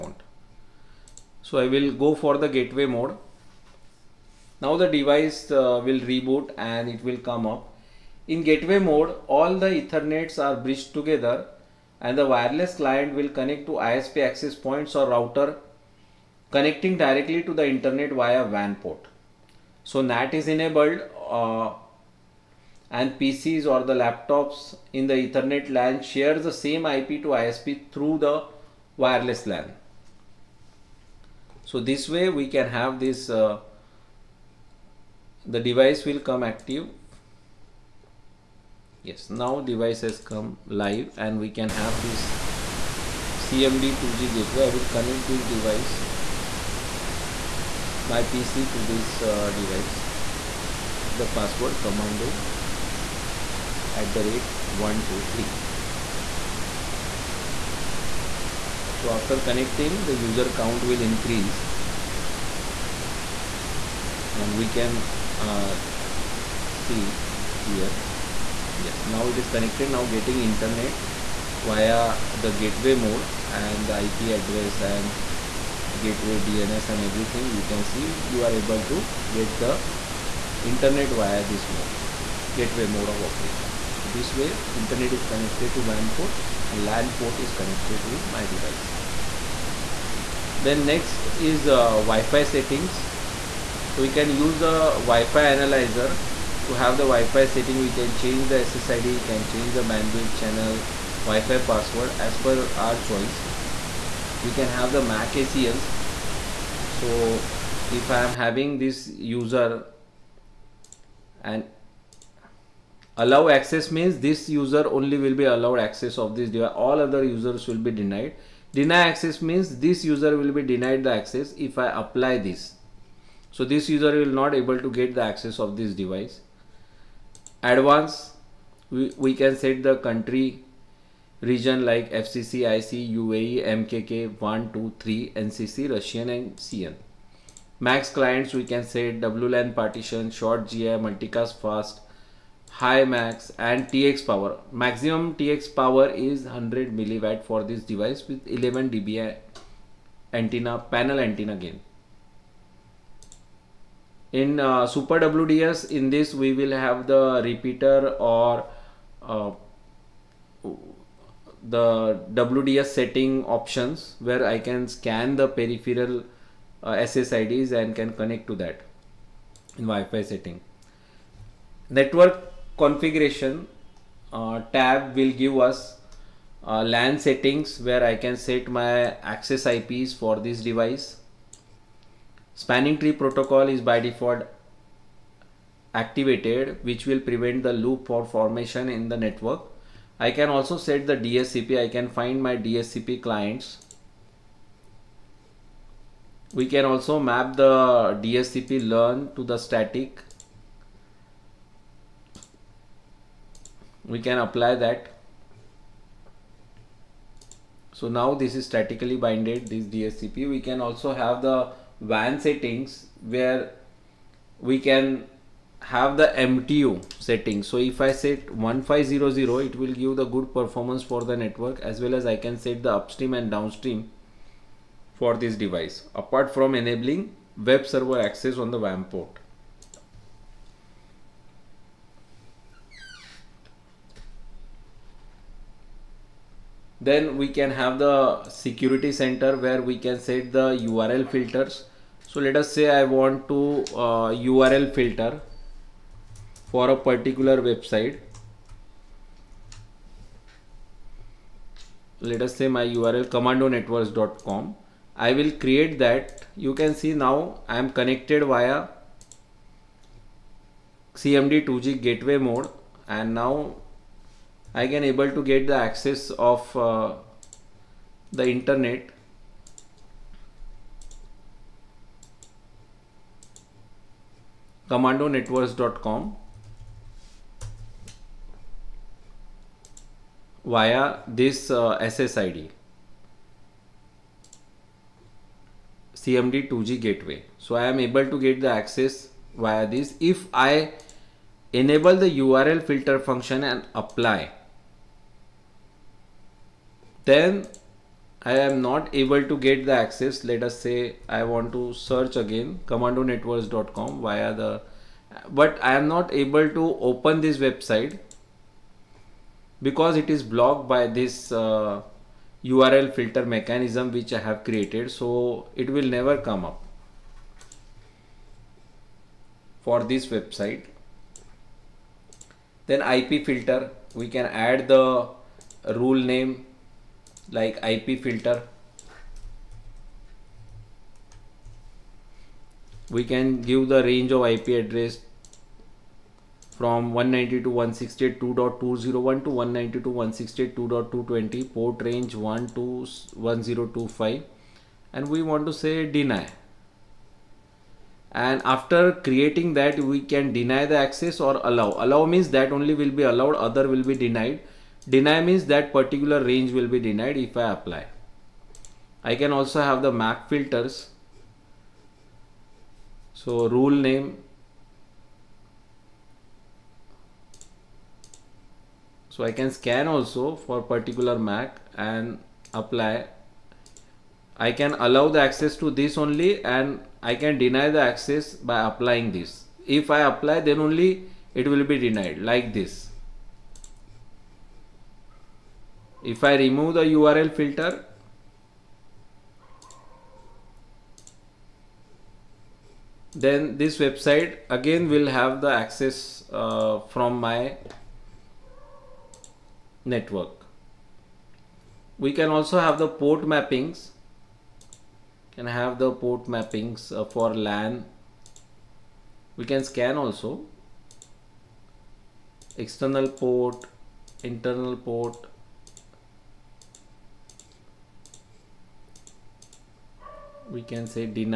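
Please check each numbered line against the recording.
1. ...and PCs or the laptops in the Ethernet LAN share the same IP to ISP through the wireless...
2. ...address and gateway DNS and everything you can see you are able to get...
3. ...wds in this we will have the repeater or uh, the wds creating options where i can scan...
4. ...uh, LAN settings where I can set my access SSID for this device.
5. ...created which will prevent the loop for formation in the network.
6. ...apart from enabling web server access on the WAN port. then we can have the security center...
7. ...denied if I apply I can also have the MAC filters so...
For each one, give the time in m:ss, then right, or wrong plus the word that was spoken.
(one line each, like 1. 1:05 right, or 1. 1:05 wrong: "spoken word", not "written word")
1. 0:22 right
2. 1:14 right
3. 2:35 wrong: "setting", not "creating"
4. 2:56 wrong: "IPs", not "SSID"
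5. 3:05 wrong: "activated", not "created"
6. 3:46 right
7. 5:56 right.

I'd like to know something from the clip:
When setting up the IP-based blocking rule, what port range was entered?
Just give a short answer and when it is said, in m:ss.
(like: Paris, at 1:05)
1 to 1025, at 5:42.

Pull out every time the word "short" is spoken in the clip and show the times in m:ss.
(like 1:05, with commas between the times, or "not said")
2:20.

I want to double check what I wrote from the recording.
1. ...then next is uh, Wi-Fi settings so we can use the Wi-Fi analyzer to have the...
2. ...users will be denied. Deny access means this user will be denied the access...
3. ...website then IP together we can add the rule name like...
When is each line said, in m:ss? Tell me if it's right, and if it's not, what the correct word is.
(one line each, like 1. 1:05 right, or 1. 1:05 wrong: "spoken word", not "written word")
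1. 1:30 right
2. 1:57 right
3. 5:20 wrong: "filter", not "together".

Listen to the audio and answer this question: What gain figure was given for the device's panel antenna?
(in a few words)
11 dBi.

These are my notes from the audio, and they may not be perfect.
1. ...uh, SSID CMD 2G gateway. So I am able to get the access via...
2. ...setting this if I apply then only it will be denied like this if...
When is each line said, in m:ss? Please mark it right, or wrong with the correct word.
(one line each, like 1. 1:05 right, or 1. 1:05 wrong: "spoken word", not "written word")
1. 4:41 right
2. 6:18 wrong: "applying", not "setting".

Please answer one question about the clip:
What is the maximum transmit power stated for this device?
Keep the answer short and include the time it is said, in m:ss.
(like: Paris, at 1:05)
100 milliwatt, at 2:26.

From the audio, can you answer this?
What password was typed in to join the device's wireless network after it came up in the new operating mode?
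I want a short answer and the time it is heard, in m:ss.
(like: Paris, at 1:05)
commando@123, at 0:51.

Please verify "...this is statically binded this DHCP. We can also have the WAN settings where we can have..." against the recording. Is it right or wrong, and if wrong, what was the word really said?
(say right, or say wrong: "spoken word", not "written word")
right.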